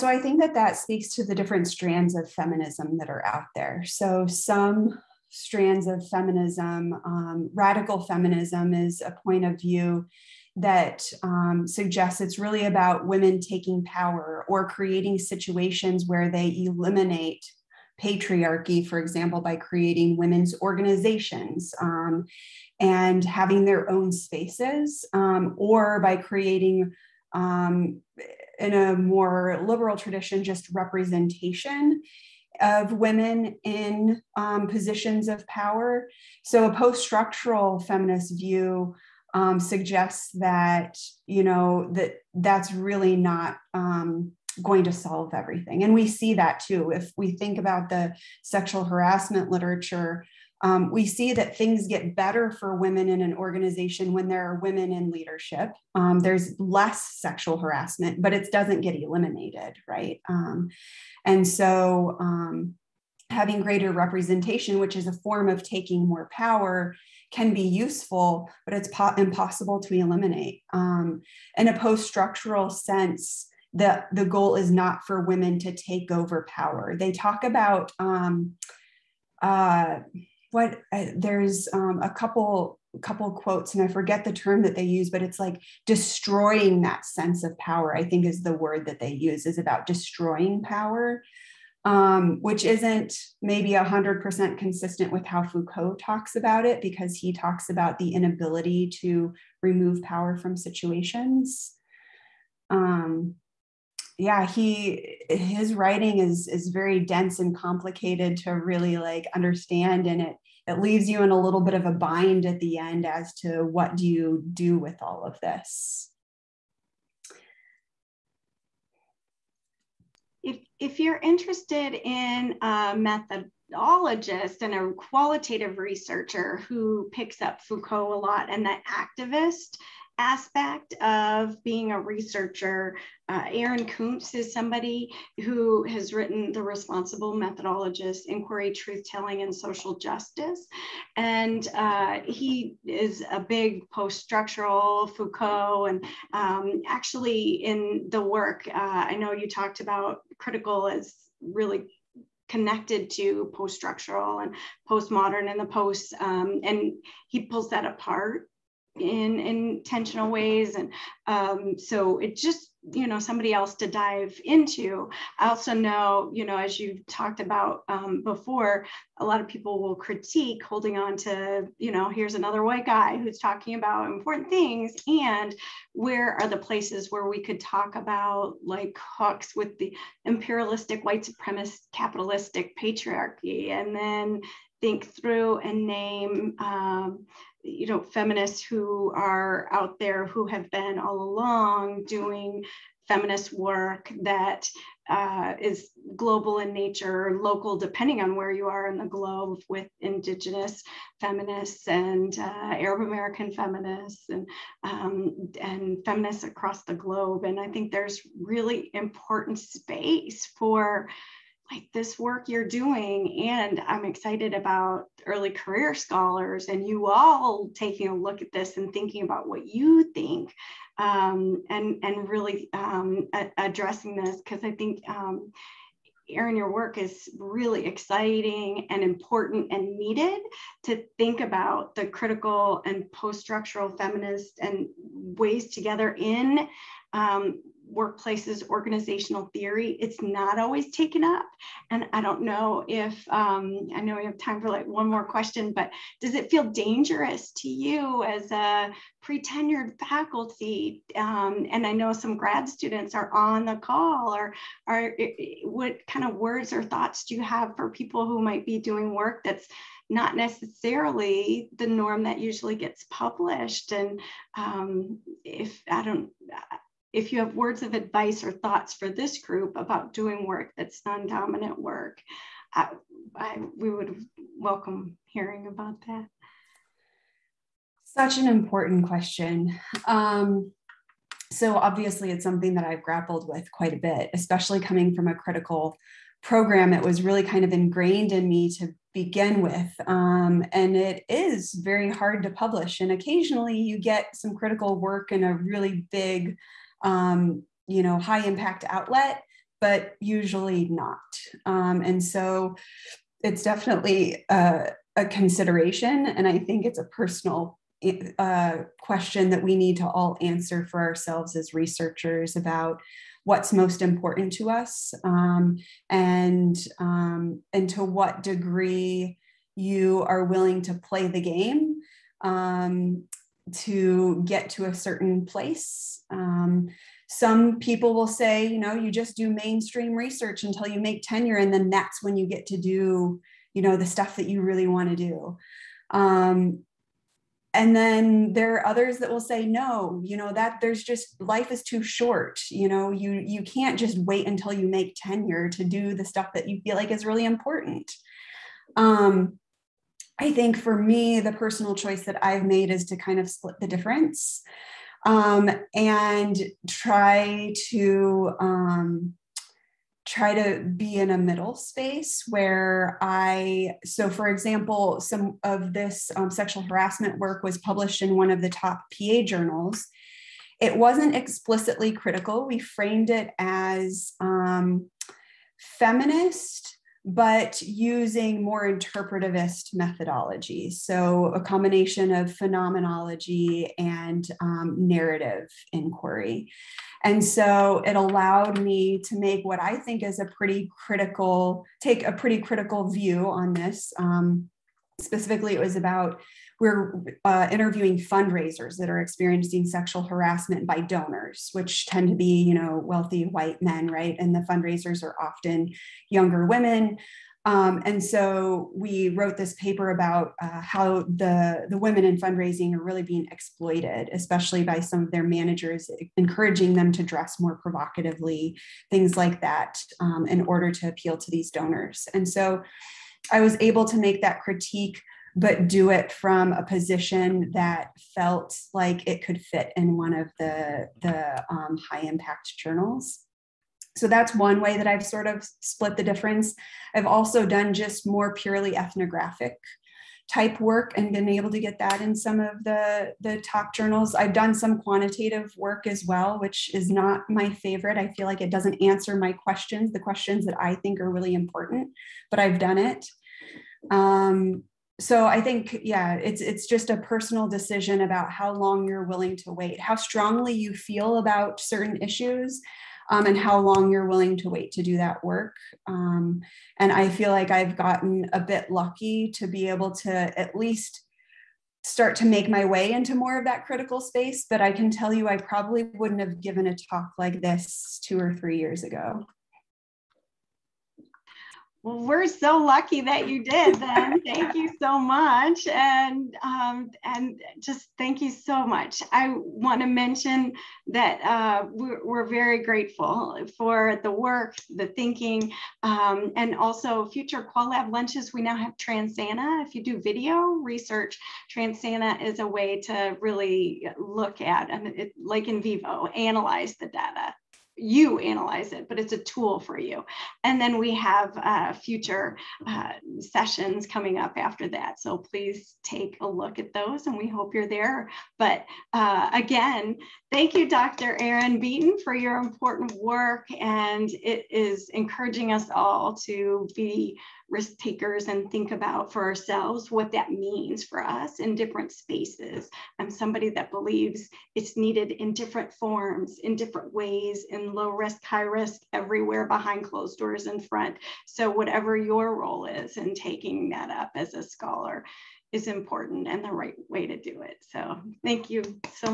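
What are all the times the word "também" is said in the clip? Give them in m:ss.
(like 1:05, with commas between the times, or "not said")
not said.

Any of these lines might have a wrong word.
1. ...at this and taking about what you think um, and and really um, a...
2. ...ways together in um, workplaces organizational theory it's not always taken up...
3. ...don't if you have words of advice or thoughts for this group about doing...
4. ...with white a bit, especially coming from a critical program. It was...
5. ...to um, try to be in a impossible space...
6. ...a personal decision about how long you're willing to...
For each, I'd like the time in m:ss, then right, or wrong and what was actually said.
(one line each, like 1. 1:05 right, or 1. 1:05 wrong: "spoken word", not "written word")
1. 3:38 wrong: "thinking", not "taking"
2. 3:55 right
3. 4:26 right
4. 4:43 wrong: "quite", not "white"
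5. 5:57 wrong: "middle", not "impossible"
6. 7:37 right.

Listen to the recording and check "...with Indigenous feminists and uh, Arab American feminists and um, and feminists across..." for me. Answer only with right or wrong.
right.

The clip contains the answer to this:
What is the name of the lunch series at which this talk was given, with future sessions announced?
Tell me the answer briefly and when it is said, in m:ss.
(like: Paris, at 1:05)
Qual Lab, at 8:17.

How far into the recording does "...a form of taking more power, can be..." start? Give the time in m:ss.
1:05.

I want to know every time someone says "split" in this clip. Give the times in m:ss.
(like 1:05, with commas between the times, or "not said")
5:53, 7:15.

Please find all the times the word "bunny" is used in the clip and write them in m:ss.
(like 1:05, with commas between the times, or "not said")
not said.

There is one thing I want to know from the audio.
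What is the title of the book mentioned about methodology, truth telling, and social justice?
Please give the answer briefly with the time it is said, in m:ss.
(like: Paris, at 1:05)
The Responsible Methodologist, at 2:16.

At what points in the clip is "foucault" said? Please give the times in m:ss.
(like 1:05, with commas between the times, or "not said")
1:35, 2:07, 2:25.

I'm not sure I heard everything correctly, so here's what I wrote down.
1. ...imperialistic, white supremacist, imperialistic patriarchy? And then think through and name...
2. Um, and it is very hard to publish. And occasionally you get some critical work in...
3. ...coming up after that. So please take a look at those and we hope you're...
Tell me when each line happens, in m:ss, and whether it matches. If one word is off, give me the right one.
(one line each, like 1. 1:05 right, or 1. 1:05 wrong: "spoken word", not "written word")
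1. 3:00 wrong: "capitalistic", not "imperialistic"
2. 4:50 right
3. 8:34 right.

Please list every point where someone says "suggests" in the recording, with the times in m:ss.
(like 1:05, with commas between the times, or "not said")
0:11, 0:39.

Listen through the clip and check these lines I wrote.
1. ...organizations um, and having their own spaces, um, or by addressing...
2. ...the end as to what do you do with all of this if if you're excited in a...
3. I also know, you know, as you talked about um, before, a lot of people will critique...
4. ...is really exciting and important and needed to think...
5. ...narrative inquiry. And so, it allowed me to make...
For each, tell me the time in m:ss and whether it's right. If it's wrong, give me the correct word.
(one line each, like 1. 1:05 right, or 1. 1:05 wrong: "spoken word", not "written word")
1. 0:20 wrong: "creating", not "addressing"
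2. 1:52 wrong: "interested", not "excited"
3. 2:45 right
4. 3:46 right
5. 6:24 right.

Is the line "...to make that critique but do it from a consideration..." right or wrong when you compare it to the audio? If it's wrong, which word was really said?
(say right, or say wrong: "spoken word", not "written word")
wrong: "position", not "consideration".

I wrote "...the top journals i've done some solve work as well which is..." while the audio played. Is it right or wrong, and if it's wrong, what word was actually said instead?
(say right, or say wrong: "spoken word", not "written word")
wrong: "quantitative", not "solve".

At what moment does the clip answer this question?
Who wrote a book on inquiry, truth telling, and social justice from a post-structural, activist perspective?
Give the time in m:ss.
2:13.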